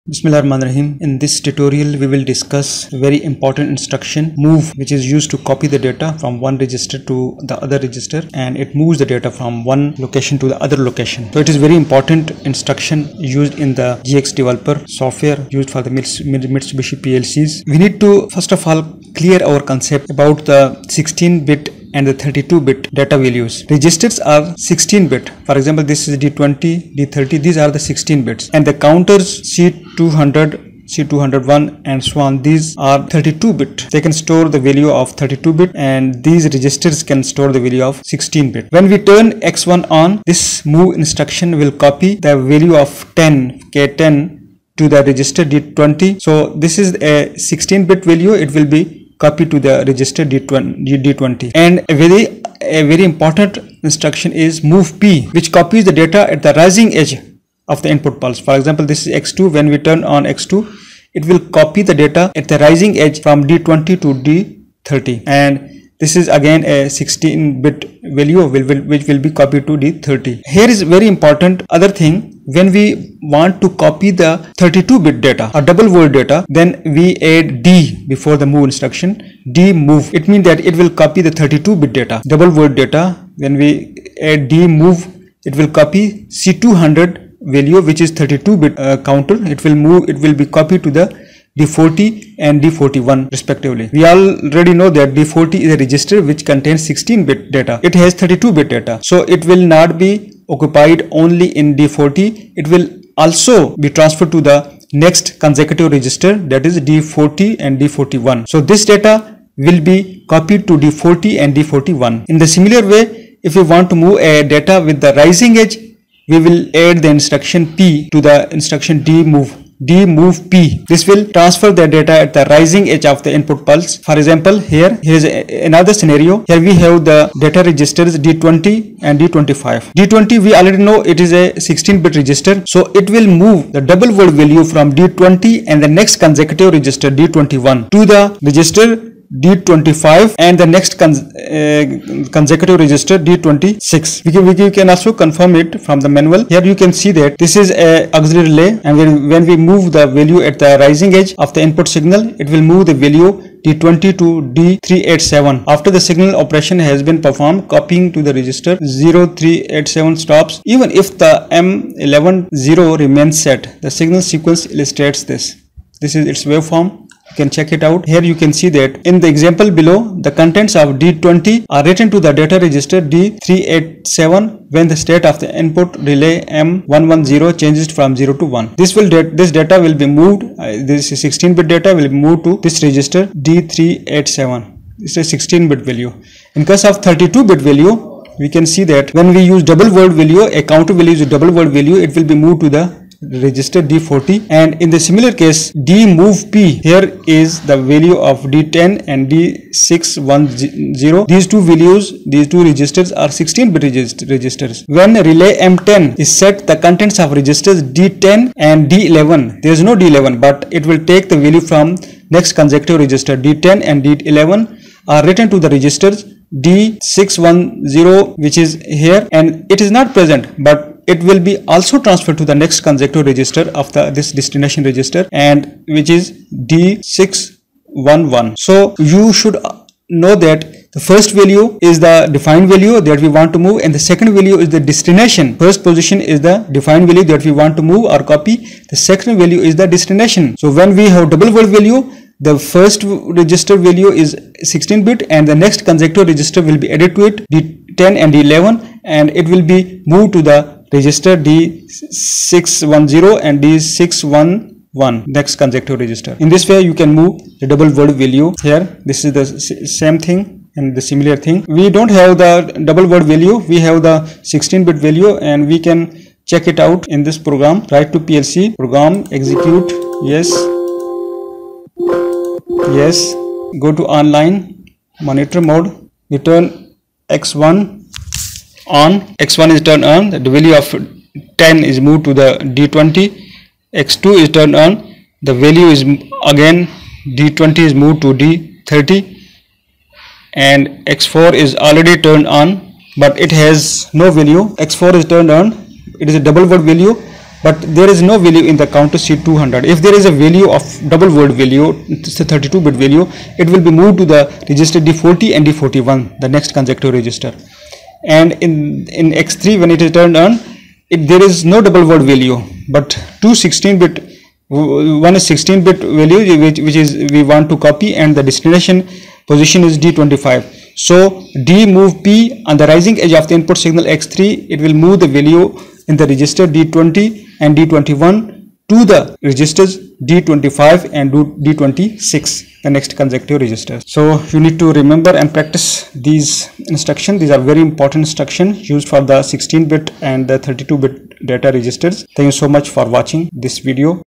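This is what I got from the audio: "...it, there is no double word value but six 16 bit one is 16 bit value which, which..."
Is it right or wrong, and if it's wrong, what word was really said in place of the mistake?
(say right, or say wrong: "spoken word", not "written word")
wrong: "two", not "six".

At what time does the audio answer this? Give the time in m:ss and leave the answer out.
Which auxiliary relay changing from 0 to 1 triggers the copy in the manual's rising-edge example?
2:56.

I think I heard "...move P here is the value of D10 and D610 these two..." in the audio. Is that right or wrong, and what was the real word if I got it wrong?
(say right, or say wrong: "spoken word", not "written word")
right.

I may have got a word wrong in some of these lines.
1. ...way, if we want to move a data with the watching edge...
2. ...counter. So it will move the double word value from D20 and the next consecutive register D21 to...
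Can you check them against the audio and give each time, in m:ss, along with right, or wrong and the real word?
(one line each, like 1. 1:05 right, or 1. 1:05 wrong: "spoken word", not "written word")
1. 1:52 wrong: "rising", not "watching"
2. 2:12 wrong: "register", not "counter".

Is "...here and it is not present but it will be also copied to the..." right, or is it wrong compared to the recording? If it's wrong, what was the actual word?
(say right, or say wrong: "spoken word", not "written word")
wrong: "transferred", not "copied".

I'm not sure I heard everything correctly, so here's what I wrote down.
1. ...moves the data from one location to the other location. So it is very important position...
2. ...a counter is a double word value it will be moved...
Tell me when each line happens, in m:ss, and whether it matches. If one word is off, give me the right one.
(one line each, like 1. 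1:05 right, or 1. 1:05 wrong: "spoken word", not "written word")
1. 0:08 wrong: "instruction", not "position"
2. 3:10 right.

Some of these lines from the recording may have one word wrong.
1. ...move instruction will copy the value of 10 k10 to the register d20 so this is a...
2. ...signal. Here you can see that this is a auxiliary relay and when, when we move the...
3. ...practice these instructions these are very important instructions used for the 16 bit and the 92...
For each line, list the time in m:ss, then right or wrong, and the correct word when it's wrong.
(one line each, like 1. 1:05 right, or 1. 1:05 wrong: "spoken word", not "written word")
1. 0:40 right
2. 2:26 wrong: "manual", not "signal"
3. 5:35 wrong: "32", not "92".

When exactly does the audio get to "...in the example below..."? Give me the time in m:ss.
2:49.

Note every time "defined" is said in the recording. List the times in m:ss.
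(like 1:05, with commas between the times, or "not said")
3:52, 3:56.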